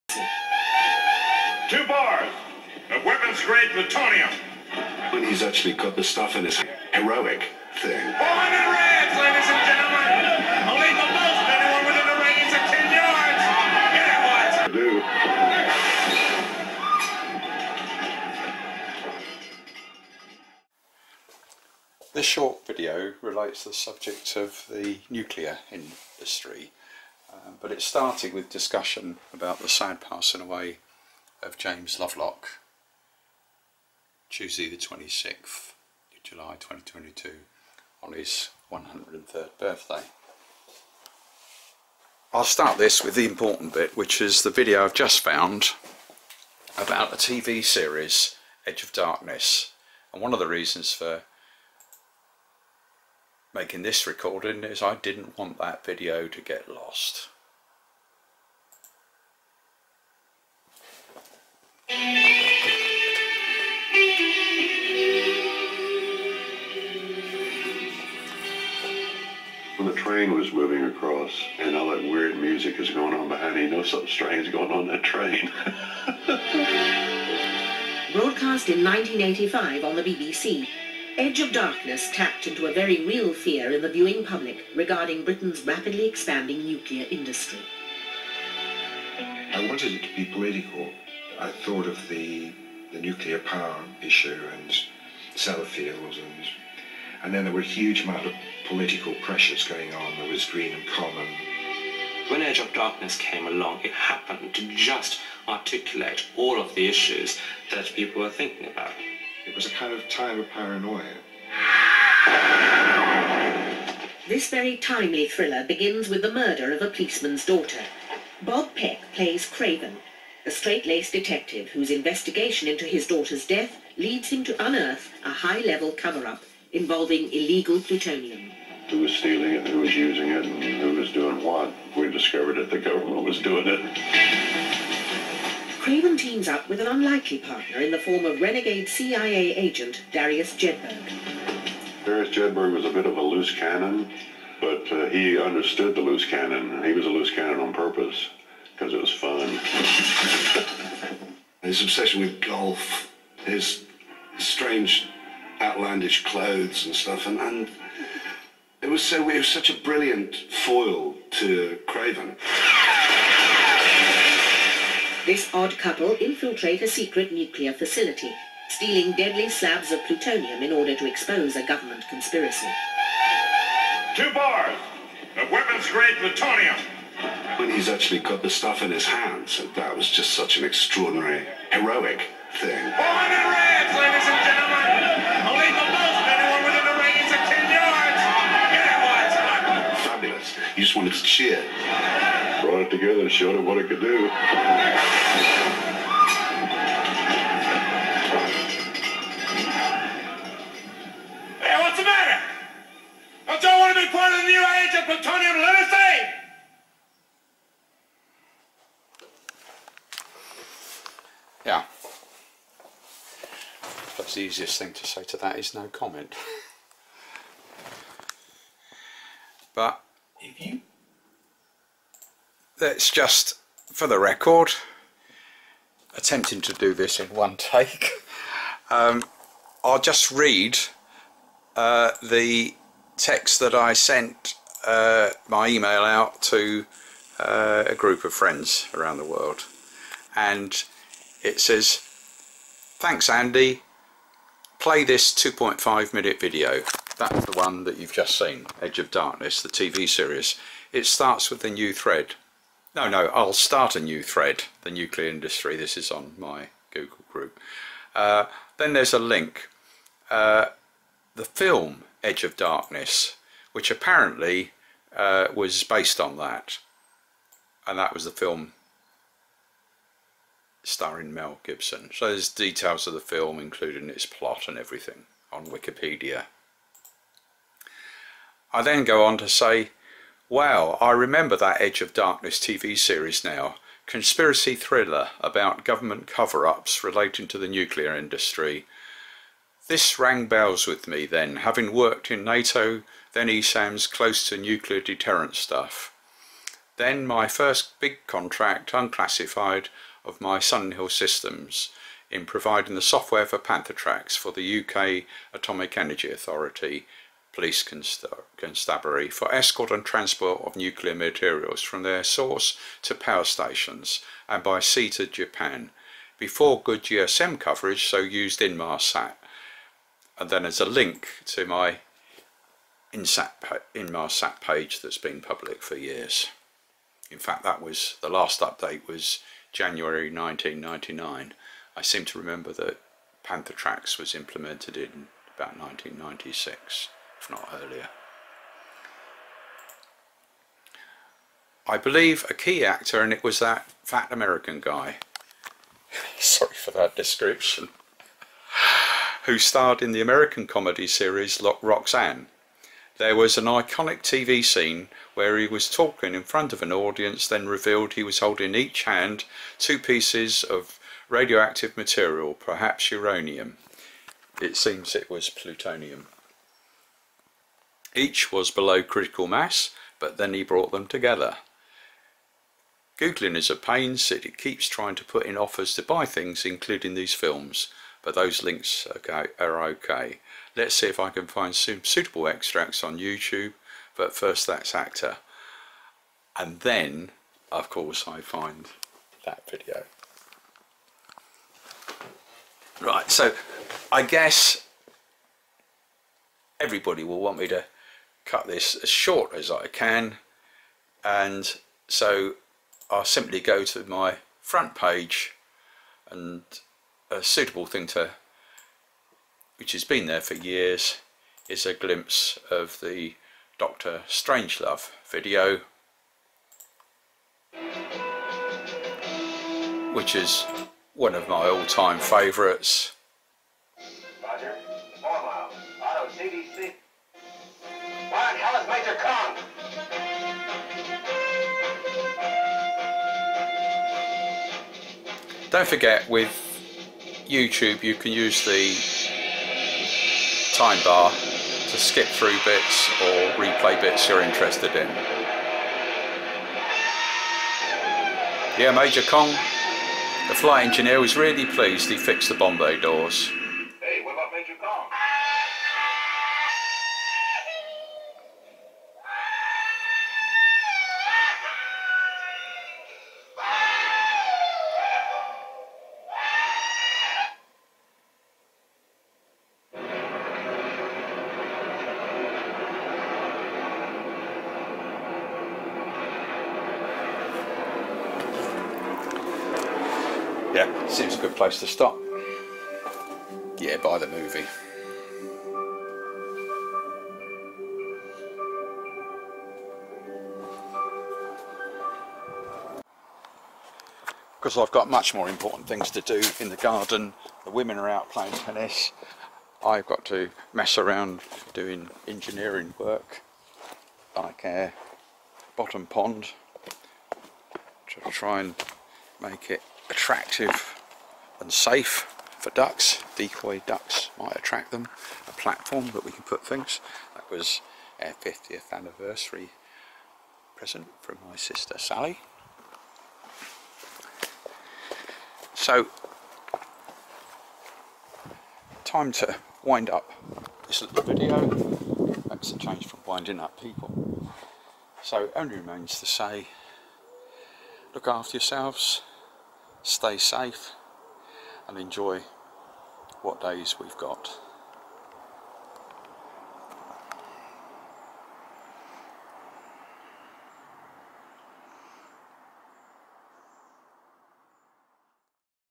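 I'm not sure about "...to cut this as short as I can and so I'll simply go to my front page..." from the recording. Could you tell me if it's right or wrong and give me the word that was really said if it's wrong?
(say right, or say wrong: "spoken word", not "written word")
right.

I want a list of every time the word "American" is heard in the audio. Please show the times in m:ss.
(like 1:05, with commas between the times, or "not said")
5:44, 5:50.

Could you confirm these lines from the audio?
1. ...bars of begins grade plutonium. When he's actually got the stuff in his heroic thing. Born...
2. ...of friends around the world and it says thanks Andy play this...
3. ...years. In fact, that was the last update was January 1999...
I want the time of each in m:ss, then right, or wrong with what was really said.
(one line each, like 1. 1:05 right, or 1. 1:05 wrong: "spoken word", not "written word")
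1. 0:01 wrong: "weapons", not "begins"
2. 3:58 right
3. 5:25 right.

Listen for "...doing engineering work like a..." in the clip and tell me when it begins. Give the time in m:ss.
8:21.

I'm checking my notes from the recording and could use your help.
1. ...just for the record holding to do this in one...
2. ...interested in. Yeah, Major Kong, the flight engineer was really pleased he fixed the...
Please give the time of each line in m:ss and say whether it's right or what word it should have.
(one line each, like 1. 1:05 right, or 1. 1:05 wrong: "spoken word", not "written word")
1. 3:43 wrong: "attempting", not "holding"
2. 7:24 right.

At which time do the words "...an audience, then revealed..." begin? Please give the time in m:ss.
5:56.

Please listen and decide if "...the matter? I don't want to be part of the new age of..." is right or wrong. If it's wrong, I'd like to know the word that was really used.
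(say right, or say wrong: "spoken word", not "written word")
right.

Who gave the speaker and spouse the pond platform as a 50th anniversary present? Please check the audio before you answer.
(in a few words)
Sally.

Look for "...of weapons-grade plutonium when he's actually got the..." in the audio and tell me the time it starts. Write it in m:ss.
2:55.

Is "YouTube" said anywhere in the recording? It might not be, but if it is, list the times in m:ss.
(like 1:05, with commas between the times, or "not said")
6:23, 7:17.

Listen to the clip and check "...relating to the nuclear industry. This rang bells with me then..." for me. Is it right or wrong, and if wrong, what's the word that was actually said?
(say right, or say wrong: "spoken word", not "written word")
right.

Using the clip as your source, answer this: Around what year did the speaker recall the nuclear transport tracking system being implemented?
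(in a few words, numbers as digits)
1996.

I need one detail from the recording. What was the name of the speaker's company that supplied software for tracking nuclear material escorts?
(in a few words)
Sunhill Systems.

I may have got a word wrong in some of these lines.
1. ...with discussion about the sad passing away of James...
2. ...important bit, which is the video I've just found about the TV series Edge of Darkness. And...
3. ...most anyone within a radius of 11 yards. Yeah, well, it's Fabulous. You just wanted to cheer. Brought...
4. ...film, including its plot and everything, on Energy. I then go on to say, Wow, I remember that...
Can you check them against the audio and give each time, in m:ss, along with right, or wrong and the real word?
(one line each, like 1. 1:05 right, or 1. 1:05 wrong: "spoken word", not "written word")
1. 0:28 right
2. 0:43 right
3. 3:05 wrong: "10", not "11"
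4. 4:33 wrong: "Wikipedia", not "Energy".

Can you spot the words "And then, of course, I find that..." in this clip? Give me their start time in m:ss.
6:26.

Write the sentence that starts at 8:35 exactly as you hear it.
A platform that we can put things.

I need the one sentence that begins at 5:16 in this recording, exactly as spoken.
Before good GSM coverage, so used Inmarsat.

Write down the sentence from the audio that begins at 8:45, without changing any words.
So time to wind up this little video.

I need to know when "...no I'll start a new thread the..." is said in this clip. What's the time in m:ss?
4:13.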